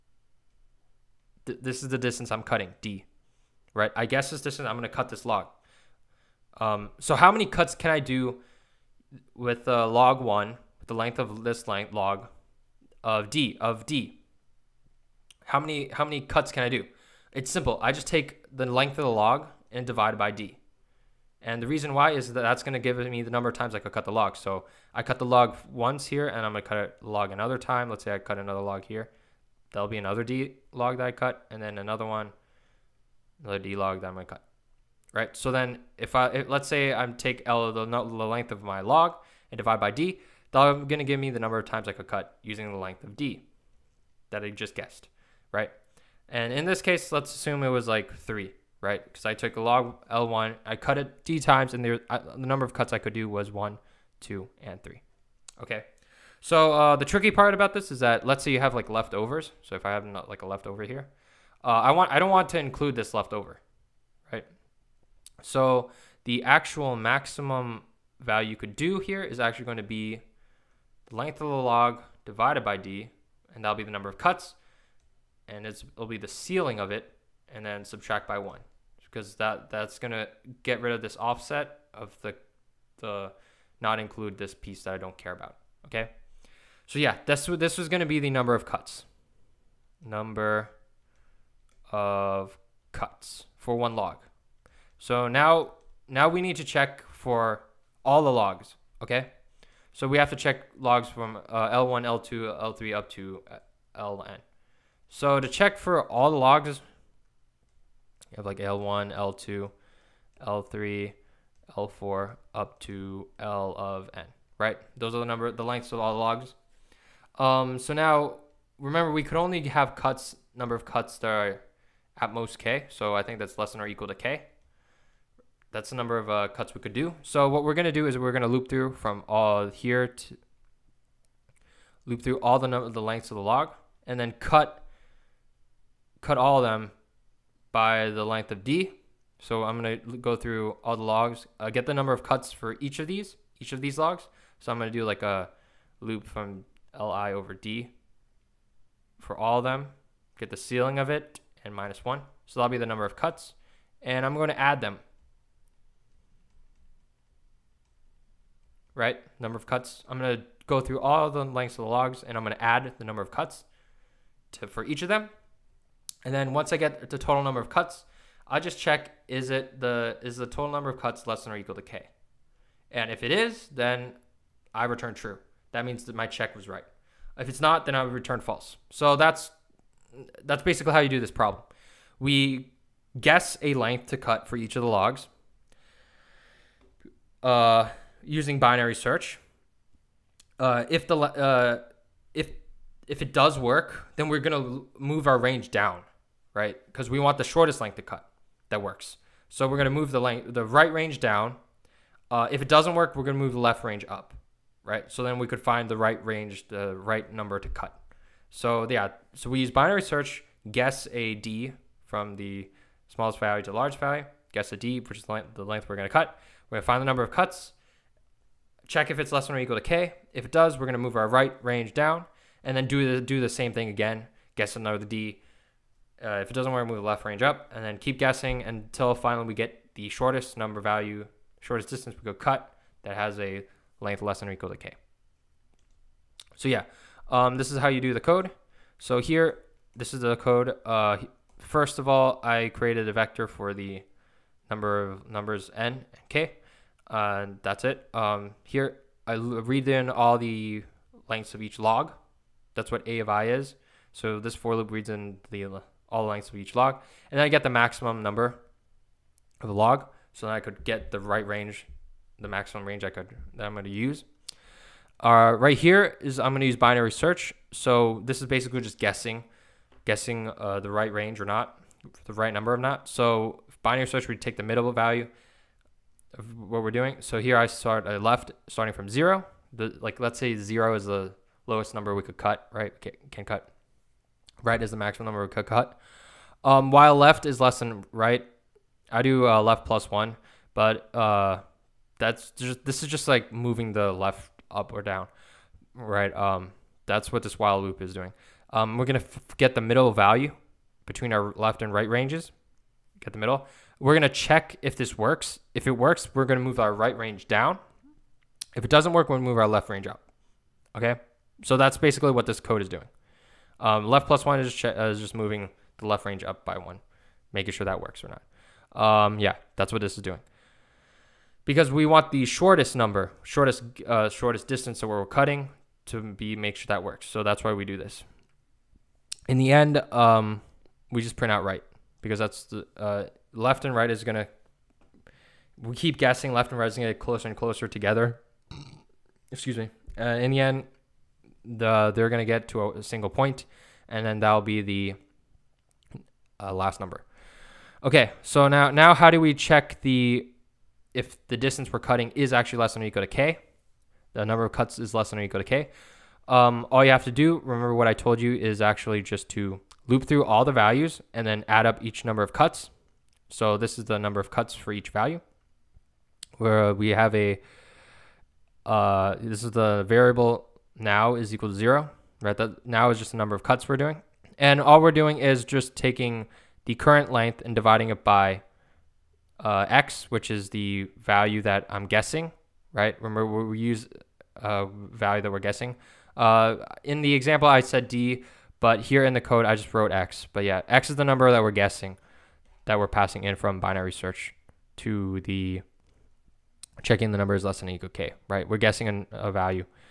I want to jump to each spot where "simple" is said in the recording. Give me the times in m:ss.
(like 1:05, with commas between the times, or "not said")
0:17.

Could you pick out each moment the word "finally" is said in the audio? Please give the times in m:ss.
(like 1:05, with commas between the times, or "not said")
3:49.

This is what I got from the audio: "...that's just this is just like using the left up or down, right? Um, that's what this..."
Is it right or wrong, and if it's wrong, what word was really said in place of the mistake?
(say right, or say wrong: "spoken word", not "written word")
wrong: "moving", not "using".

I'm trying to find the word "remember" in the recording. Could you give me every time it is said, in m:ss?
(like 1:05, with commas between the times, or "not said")
1:58, 5:57, 6:23.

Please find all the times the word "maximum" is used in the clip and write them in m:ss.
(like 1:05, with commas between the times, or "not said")
1:06, 4:17, 4:22, 4:44.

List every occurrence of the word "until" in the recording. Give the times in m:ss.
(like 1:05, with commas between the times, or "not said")
3:48.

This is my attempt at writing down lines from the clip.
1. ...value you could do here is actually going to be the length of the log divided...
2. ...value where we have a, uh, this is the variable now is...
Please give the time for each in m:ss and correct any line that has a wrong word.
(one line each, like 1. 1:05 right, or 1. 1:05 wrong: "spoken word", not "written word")
1. 1:08 right
2. 6:05 right.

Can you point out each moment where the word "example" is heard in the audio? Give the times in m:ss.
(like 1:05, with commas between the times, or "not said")
6:27.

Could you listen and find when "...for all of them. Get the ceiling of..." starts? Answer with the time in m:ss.
2:29.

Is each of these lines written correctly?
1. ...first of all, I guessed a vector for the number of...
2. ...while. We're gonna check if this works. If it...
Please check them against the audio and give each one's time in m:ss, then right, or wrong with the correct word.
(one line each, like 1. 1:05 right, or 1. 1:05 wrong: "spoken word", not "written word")
1. 4:01 wrong: "created", not "guessed"
2. 5:03 wrong: "middle", not "while".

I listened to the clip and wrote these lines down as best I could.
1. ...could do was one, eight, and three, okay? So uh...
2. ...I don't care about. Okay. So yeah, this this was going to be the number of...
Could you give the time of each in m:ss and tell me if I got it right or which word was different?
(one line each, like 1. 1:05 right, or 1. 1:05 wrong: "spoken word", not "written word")
1. 0:52 wrong: "two", not "eight"
2. 1:24 right.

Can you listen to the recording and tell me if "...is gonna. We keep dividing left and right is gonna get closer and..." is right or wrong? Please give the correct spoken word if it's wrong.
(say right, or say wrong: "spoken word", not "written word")
wrong: "guessing", not "dividing".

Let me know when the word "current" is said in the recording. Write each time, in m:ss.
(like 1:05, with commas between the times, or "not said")
6:16.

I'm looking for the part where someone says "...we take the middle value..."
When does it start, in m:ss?
4:34.